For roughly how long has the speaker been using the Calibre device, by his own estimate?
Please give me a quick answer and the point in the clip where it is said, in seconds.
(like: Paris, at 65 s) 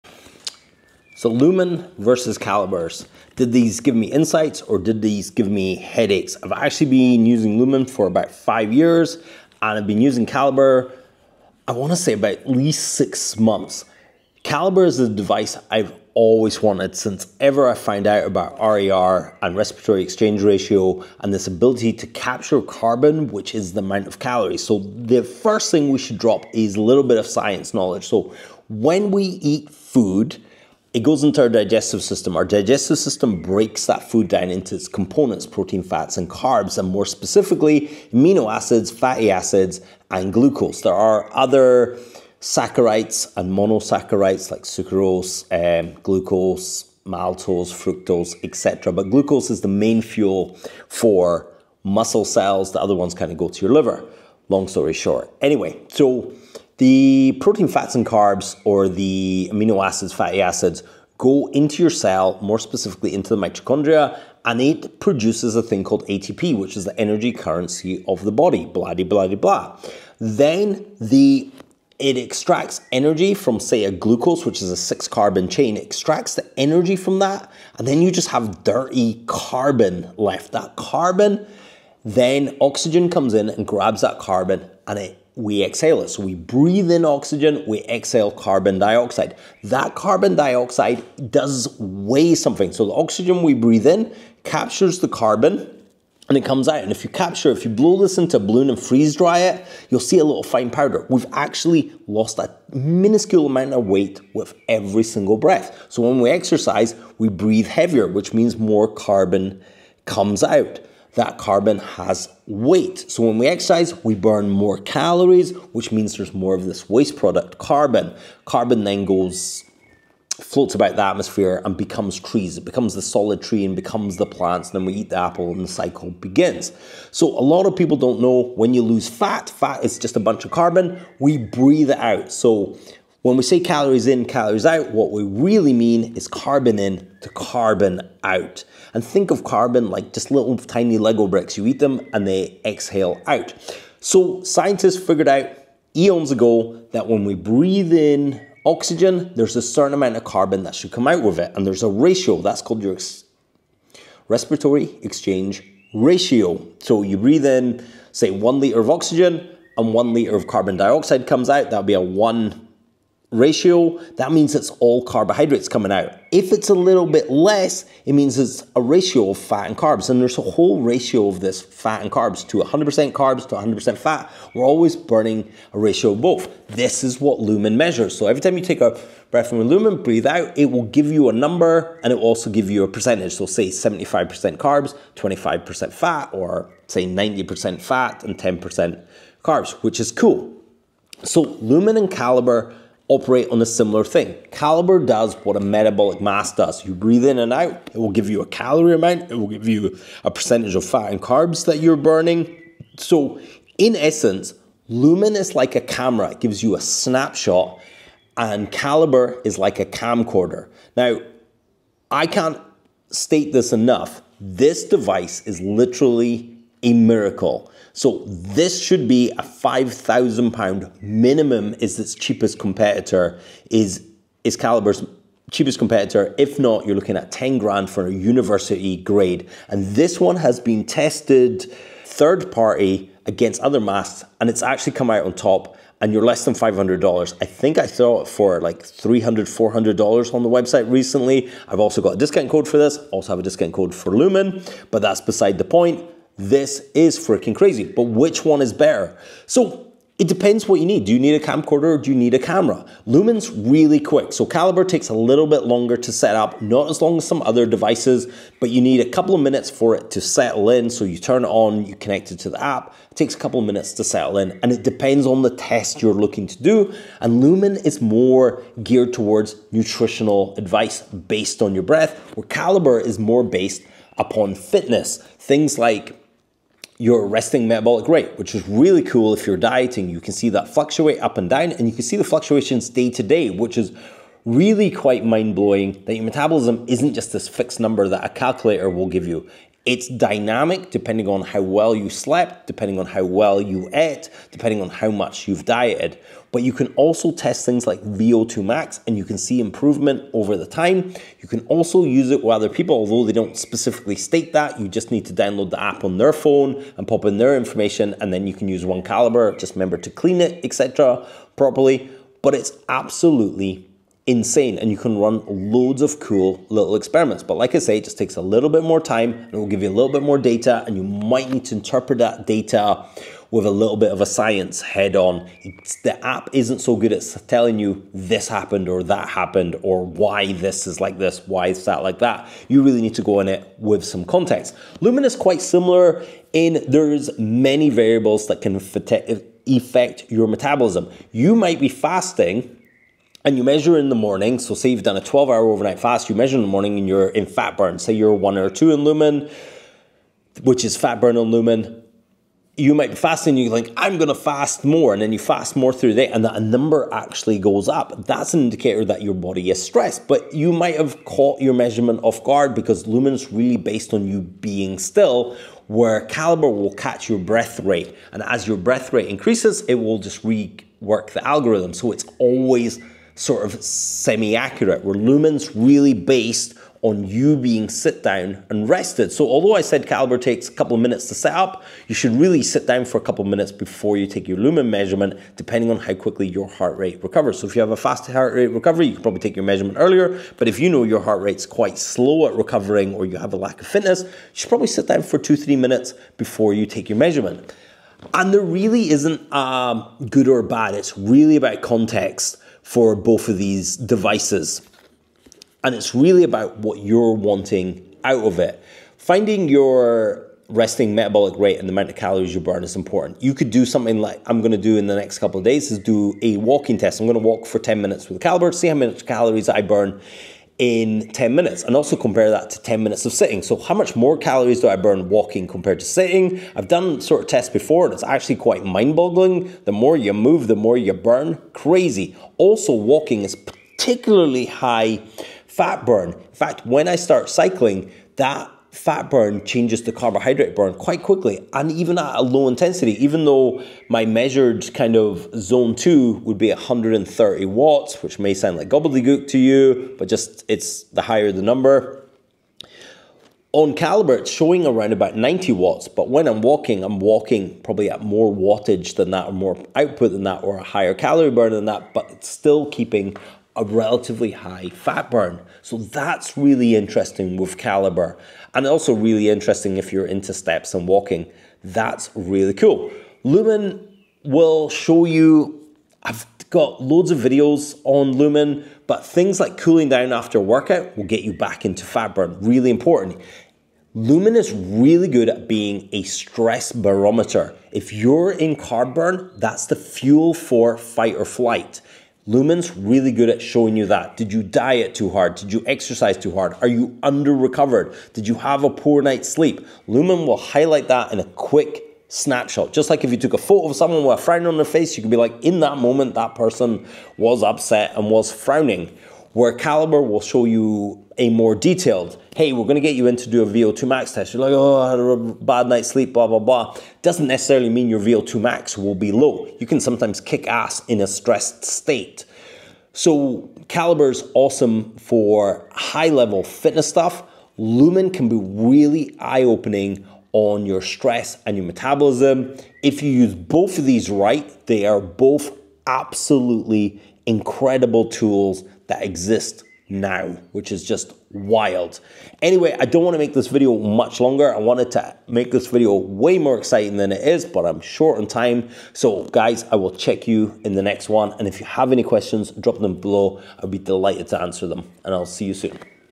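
6 months, at 12 s.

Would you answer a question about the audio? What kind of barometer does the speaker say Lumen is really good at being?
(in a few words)
stress barometer.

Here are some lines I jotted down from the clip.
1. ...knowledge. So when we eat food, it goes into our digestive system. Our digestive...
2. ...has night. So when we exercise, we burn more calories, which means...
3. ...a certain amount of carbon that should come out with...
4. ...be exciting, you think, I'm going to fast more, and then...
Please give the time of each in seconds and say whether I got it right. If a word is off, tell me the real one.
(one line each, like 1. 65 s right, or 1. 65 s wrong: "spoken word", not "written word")
1. 27 s right
2. 111 s wrong: "weight", not "night"
3. 149 s right
4. 353 s wrong: "fasting", not "exciting".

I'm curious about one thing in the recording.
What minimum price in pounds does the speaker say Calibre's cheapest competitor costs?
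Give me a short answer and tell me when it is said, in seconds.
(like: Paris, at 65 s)
£5,000, at 219 s.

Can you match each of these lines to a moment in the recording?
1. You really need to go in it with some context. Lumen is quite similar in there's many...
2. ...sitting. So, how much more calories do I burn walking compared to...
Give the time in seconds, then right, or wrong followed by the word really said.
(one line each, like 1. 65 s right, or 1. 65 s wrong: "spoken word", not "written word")
1. 332 s right
2. 423 s right.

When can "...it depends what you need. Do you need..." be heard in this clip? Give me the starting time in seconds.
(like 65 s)
250 s.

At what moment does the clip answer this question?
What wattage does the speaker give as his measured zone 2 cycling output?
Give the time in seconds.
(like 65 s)
446 s.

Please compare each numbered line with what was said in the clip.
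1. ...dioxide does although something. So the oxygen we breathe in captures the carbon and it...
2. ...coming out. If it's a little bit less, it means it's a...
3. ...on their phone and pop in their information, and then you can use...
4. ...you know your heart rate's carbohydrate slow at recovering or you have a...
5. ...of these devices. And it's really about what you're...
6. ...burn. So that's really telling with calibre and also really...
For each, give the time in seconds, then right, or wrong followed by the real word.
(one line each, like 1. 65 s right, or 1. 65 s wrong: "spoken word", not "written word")
1. 90 s wrong: "weigh", not "although"
2. 165 s right
3. 306 s right
4. 390 s wrong: "quite", not "carbohydrate"
5. 403 s right
6. 465 s wrong: "interesting", not "telling".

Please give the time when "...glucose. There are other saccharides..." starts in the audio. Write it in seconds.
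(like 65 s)
40 s.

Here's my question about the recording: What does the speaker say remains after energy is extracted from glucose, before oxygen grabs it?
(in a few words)
dirty carbon.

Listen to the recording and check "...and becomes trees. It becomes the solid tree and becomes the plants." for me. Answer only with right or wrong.
right.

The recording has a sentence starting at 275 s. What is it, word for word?
Things like your resting metabolic rate, which is really cool if you're dieting.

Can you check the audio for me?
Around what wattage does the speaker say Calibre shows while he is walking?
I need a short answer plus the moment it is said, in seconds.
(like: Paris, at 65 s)
90 watts, at 455 s.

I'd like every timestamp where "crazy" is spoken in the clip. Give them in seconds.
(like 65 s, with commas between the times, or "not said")
247 s, 431 s.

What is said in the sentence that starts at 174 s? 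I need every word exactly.
We're always burning a ratio of both.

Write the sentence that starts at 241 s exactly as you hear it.
I've also got a discount code for this, also have a discount code for Lumen, but that's beside the point.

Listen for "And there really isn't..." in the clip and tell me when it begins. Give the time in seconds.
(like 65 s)
398 s.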